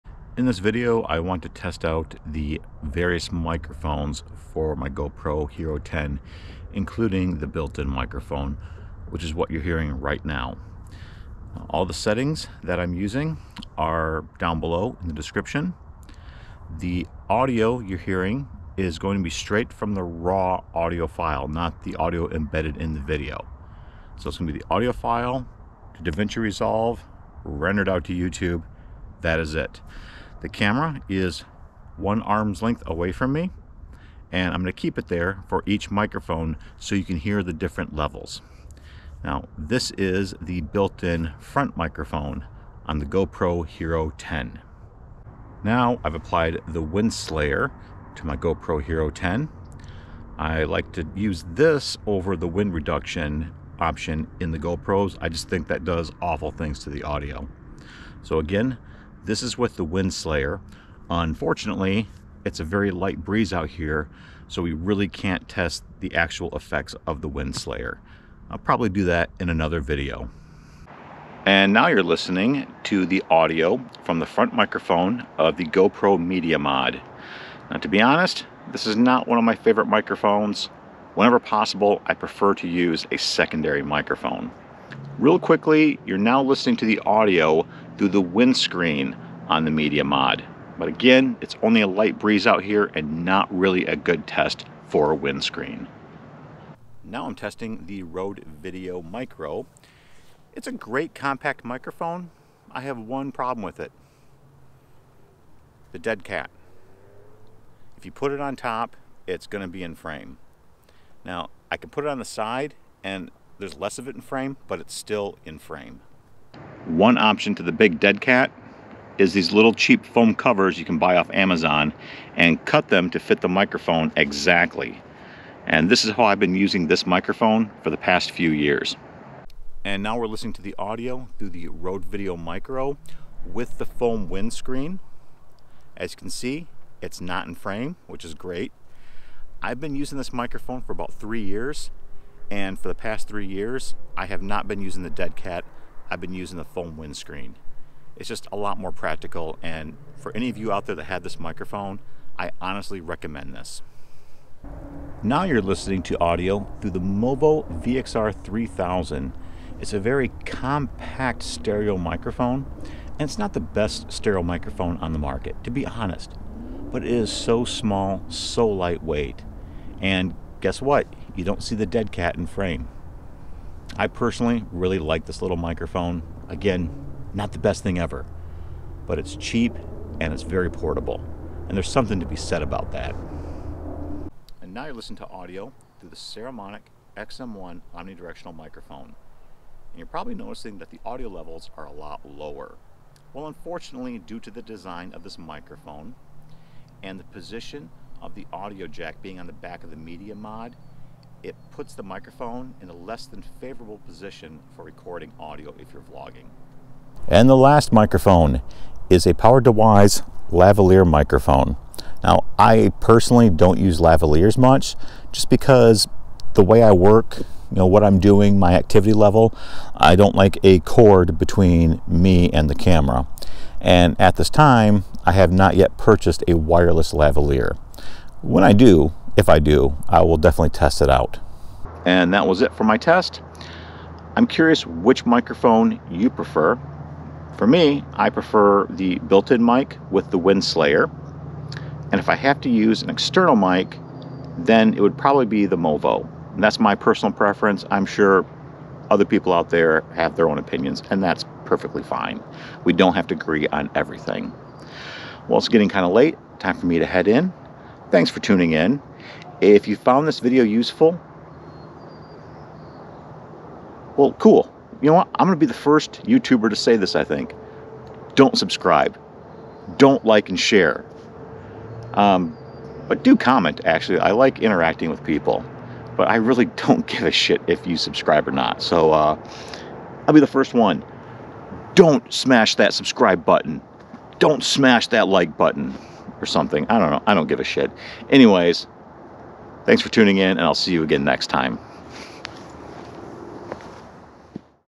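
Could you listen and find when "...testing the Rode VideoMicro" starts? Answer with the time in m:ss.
1:37.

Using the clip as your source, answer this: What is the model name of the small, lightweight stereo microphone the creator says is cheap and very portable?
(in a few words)
Movo VXR 3000.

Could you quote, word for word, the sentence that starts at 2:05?
And this is how I've been using this microphone for the past few years.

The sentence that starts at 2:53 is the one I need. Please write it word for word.
I personally really like this little microphone.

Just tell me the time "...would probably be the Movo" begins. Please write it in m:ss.
4:05.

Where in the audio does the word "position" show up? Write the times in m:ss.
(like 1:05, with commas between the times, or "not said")
3:17, 3:24.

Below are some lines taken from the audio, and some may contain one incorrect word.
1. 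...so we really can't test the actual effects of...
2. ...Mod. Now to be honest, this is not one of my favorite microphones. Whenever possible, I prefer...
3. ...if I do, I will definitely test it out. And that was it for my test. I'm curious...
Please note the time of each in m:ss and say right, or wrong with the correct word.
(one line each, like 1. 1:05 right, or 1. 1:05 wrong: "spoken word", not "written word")
1. 1:04 right
2. 1:16 right
3. 3:49 right.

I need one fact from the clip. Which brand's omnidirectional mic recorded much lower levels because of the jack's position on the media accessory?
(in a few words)
Saramonic.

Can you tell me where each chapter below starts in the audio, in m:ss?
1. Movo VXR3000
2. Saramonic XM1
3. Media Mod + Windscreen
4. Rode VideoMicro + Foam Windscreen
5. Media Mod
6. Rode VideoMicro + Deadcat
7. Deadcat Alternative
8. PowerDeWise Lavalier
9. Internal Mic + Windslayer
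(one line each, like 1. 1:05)
1. 2:34
2. 3:04
3. 1:24
4. 2:09
5. 1:10
6. 1:36
7. 1:56
8. 3:26
9. 0:45.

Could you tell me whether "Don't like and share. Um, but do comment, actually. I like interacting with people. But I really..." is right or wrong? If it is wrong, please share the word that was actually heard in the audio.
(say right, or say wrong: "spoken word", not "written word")
right.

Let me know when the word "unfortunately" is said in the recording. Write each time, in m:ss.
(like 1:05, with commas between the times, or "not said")
1:01, 3:13.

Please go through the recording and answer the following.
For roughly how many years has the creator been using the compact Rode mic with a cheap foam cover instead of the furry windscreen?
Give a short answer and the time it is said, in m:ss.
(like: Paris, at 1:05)
3 years, at 2:20.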